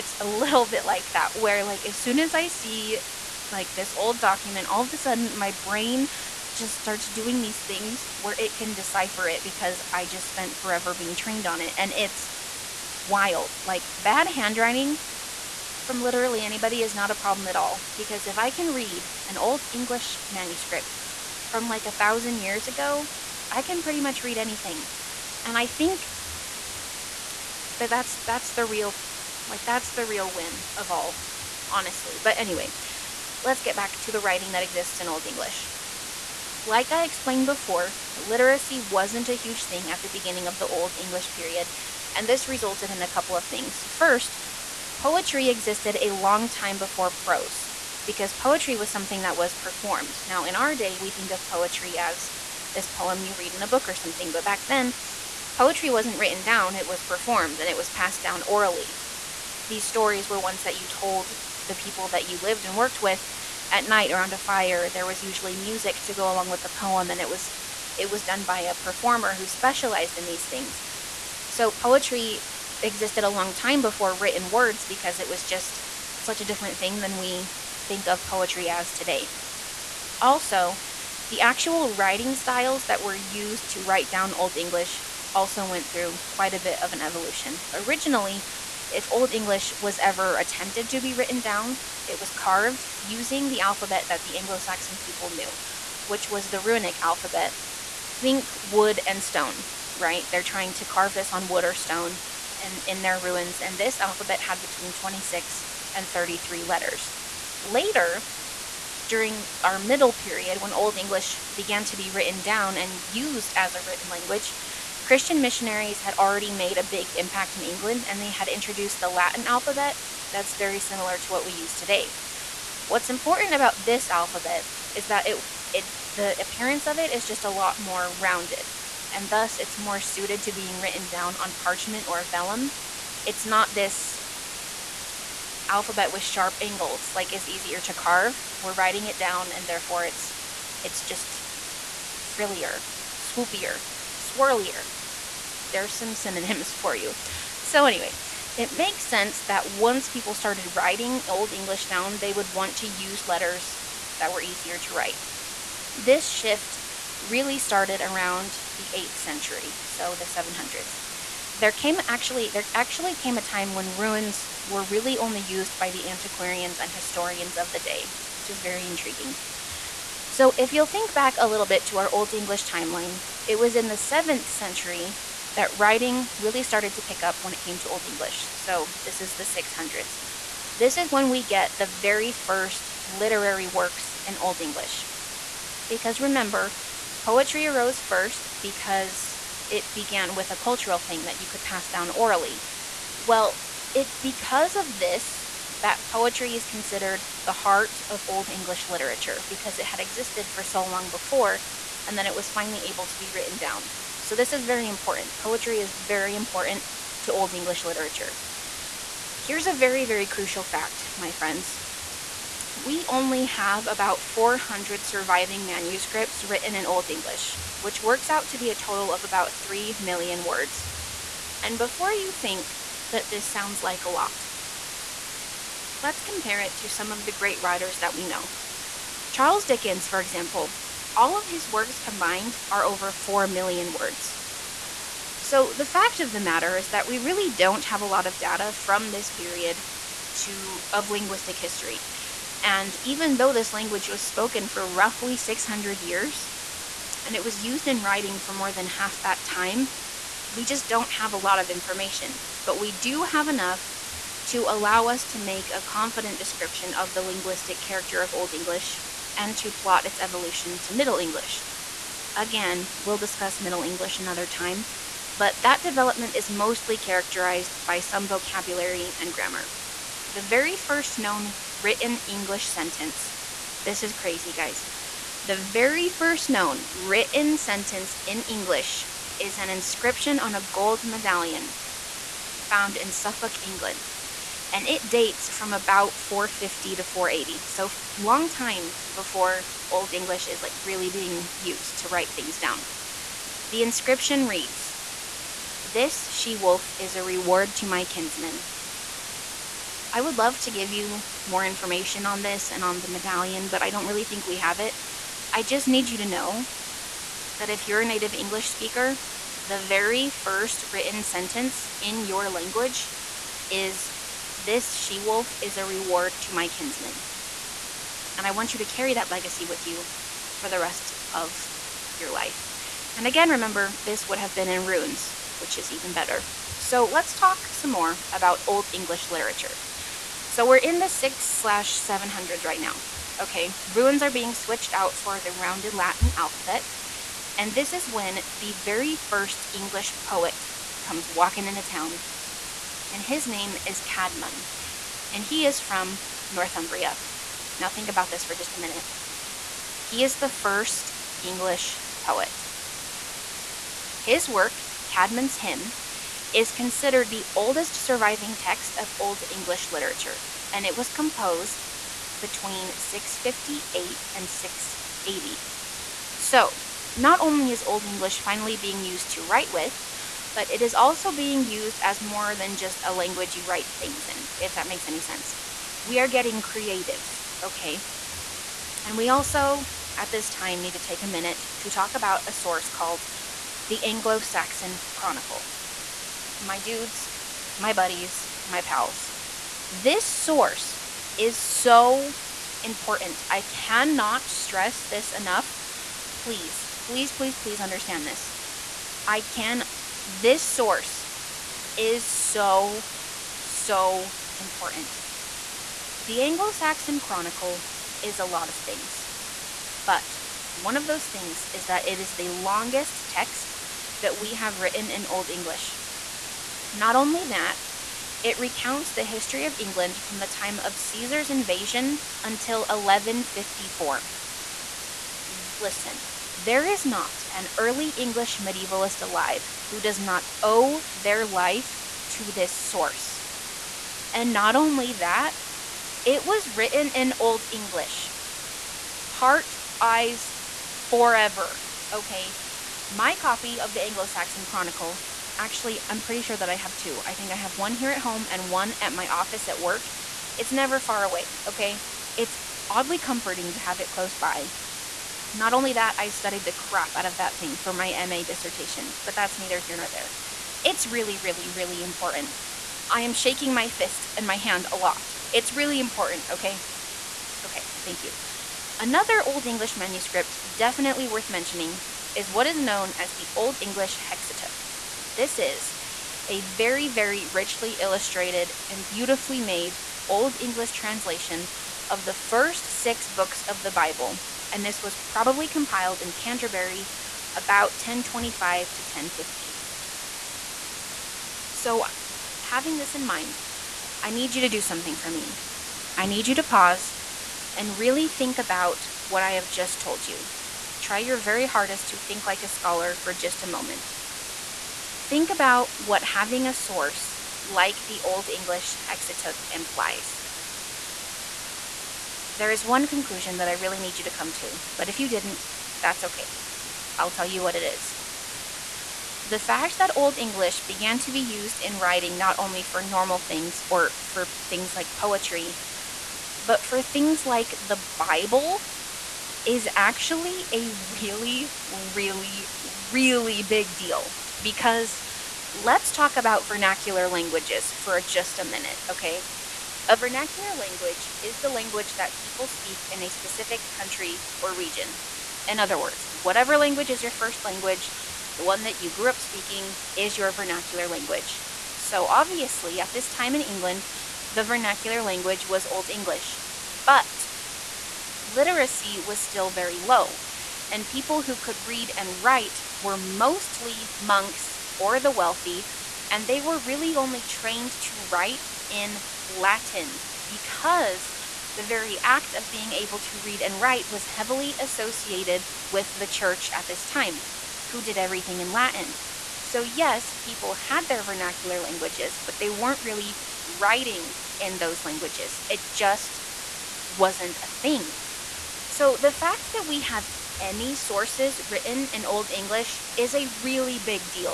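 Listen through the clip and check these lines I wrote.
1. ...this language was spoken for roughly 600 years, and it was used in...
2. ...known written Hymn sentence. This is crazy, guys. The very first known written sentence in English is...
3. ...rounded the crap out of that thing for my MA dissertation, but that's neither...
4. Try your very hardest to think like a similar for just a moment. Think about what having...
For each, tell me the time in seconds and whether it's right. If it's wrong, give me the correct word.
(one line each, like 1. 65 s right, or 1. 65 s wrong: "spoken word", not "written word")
1. 243 s right
2. 271 s wrong: "English", not "Hymn"
3. 456 s wrong: "studied", not "rounded"
4. 500 s wrong: "scholar", not "similar".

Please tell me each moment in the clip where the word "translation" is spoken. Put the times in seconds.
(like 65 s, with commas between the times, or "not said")
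480 s.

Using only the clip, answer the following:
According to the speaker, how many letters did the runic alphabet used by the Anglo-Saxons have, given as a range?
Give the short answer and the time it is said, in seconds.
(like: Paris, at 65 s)
26 to 33, at 104 s.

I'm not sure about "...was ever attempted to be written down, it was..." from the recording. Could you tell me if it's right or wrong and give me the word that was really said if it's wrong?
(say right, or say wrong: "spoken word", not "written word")
right.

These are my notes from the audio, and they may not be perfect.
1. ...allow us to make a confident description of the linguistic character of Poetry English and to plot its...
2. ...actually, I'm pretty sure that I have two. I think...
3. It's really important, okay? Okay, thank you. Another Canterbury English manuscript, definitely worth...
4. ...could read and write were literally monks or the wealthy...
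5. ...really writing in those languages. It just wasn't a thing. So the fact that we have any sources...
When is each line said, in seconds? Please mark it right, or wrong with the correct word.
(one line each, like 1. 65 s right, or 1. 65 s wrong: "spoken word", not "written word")
1. 254 s wrong: "Old", not "Poetry"
2. 445 s right
3. 465 s wrong: "Old", not "Canterbury"
4. 561 s wrong: "mostly", not "literally"
5. 583 s right.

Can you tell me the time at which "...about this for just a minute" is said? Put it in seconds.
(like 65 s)
348 s.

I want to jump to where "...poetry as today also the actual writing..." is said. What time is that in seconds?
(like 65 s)
78 s.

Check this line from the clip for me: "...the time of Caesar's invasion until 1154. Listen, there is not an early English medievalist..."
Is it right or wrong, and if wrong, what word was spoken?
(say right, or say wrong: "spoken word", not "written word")
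right.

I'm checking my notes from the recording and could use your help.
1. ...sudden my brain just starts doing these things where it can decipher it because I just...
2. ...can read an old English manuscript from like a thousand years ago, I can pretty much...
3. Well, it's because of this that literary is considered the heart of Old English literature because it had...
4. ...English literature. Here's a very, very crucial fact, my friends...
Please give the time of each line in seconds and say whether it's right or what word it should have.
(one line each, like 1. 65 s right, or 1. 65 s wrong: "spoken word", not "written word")
1. 4 s right
2. 18 s right
3. 193 s wrong: "poetry", not "literary"
4. 207 s right.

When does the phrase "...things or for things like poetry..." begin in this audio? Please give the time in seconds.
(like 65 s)
523 s.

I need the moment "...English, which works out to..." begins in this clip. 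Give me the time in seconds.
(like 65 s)
217 s.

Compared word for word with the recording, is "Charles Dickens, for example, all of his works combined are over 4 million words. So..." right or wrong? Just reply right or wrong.
right.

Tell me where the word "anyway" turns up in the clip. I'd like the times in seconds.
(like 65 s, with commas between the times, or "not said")
32 s, 147 s.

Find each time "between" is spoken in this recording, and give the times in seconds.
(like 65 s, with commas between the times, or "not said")
104 s, 362 s.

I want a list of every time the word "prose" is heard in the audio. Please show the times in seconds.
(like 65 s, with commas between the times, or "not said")
47 s.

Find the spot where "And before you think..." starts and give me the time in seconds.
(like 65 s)
221 s.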